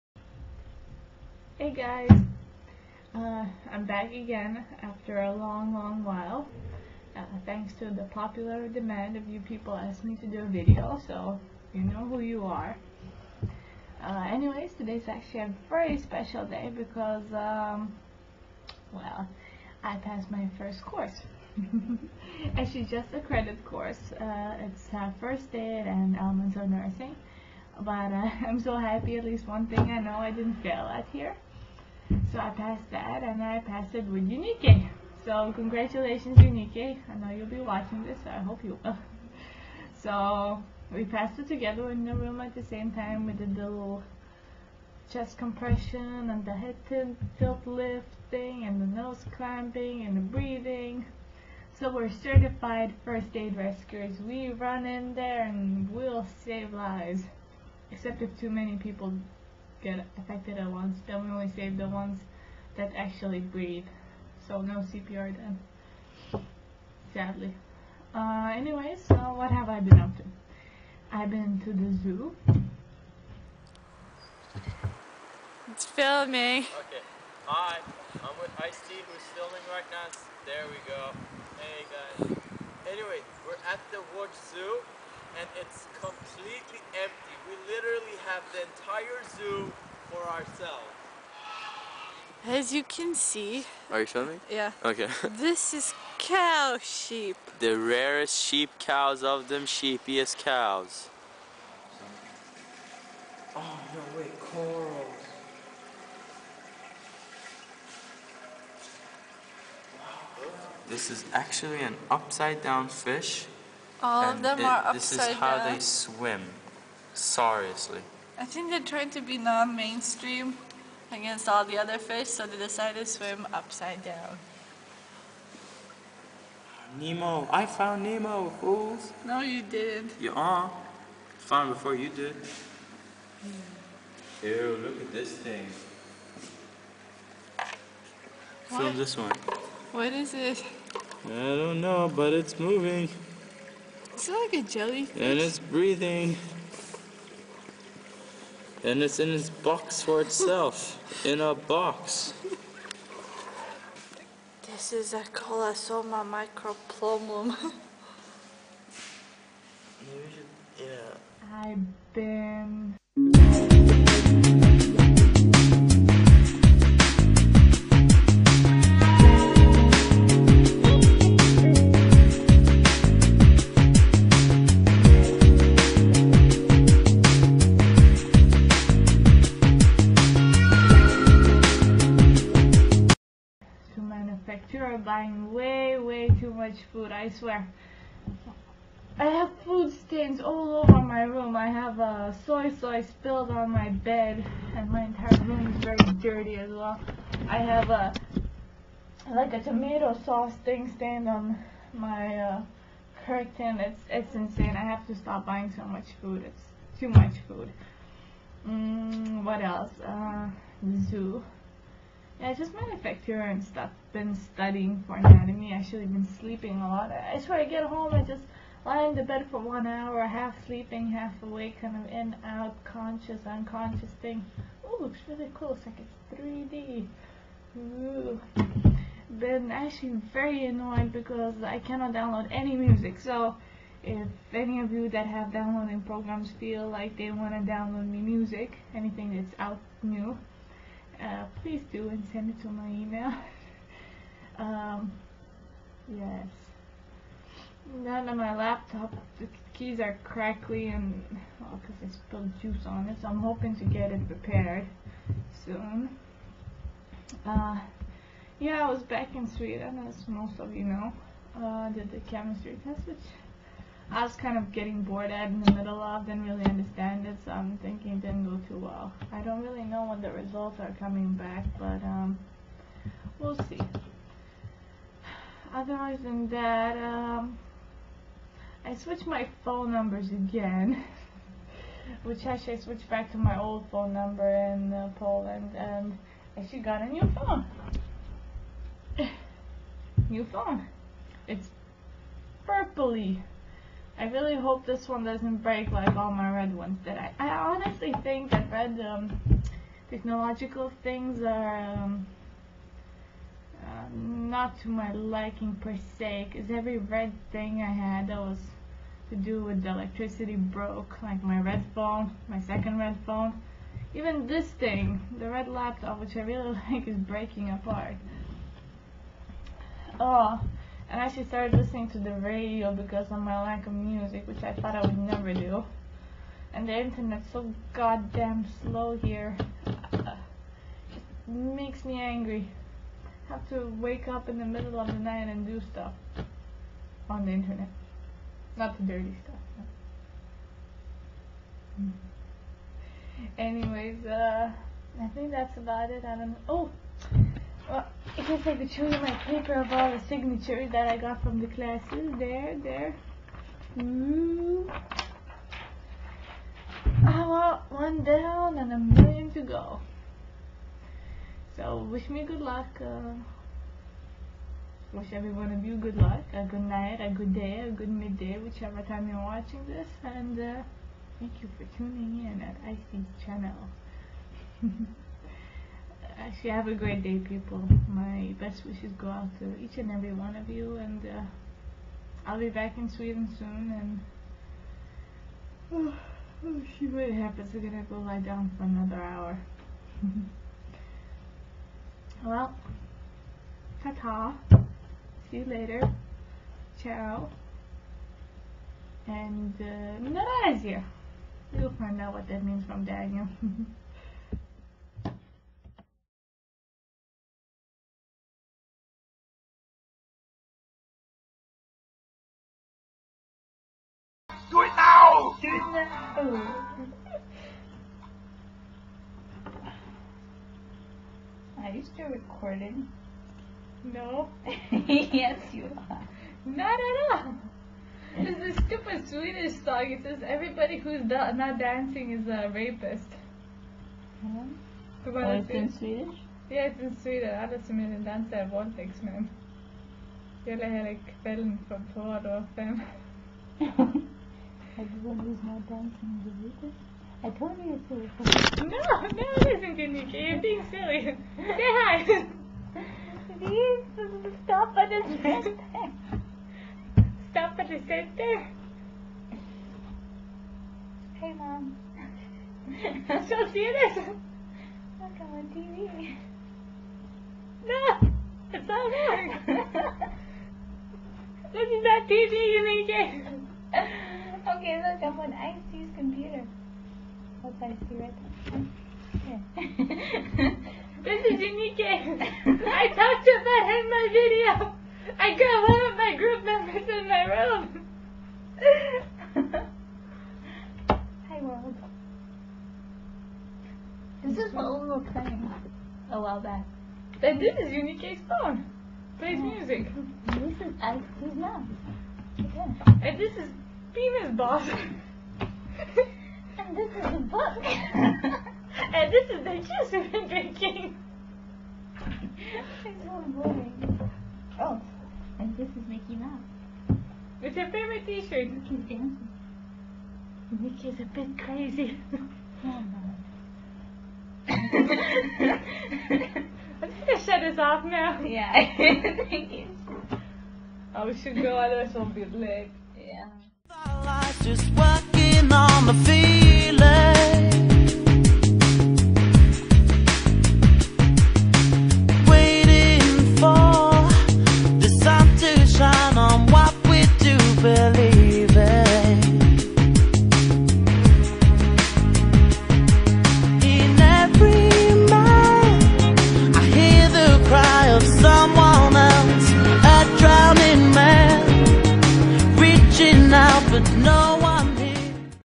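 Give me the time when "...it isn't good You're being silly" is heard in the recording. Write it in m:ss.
7:29.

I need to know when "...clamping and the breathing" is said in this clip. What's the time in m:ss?
0:49.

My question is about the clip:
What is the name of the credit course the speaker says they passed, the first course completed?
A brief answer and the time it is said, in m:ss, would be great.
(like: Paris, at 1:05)
First aid and elements of nursing, at 0:25.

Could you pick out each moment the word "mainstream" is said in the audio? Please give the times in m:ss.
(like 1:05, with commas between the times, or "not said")
1:59.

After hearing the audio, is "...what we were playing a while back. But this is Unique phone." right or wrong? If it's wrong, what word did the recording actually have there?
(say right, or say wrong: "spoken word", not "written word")
right.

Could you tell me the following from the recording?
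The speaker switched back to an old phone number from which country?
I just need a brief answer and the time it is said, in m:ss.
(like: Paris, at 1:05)
Poland, at 4:45.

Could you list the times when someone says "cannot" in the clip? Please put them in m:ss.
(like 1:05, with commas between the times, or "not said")
3:51.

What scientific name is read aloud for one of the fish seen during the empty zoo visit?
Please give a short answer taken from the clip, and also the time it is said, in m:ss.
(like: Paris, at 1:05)
Colossoma macropomum, at 2:35.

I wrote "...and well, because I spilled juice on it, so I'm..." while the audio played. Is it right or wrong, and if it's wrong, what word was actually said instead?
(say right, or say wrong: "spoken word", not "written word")
right.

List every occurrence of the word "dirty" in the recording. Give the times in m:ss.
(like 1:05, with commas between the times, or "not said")
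3:16, 5:39.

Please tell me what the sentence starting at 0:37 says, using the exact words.
I know you'll be watching this, so I hope you will.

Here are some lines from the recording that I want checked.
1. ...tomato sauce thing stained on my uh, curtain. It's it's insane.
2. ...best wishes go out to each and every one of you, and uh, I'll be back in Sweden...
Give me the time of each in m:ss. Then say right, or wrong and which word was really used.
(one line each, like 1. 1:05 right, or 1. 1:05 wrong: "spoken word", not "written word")
1. 3:19 right
2. 6:18 right.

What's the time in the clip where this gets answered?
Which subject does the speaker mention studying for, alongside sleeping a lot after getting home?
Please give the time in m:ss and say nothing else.
3:35.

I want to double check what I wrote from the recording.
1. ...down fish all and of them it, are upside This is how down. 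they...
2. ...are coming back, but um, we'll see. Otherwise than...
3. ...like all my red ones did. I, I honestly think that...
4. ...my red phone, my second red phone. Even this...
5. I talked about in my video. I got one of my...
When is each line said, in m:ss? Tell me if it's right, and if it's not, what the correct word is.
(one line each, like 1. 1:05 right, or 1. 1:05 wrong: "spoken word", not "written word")
1. 1:52 right
2. 4:30 right
3. 4:55 right
4. 5:11 right
5. 8:02 right.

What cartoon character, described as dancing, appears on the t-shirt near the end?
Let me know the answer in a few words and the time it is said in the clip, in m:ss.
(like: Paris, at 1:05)
Mickey Mouse, at 8:36.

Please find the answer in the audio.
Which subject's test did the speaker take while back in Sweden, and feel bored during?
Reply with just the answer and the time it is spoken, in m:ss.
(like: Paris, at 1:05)
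Chemistry, at 4:22.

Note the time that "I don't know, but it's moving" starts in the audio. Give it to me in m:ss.
2:21.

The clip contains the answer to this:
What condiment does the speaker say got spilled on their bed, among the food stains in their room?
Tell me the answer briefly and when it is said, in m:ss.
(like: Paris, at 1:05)
Soy sauce, at 3:12.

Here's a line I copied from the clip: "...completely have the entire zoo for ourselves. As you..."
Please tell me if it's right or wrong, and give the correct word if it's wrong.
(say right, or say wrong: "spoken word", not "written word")
wrong: "literally", not "completely".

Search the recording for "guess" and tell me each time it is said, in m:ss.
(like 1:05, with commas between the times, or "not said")
5:48.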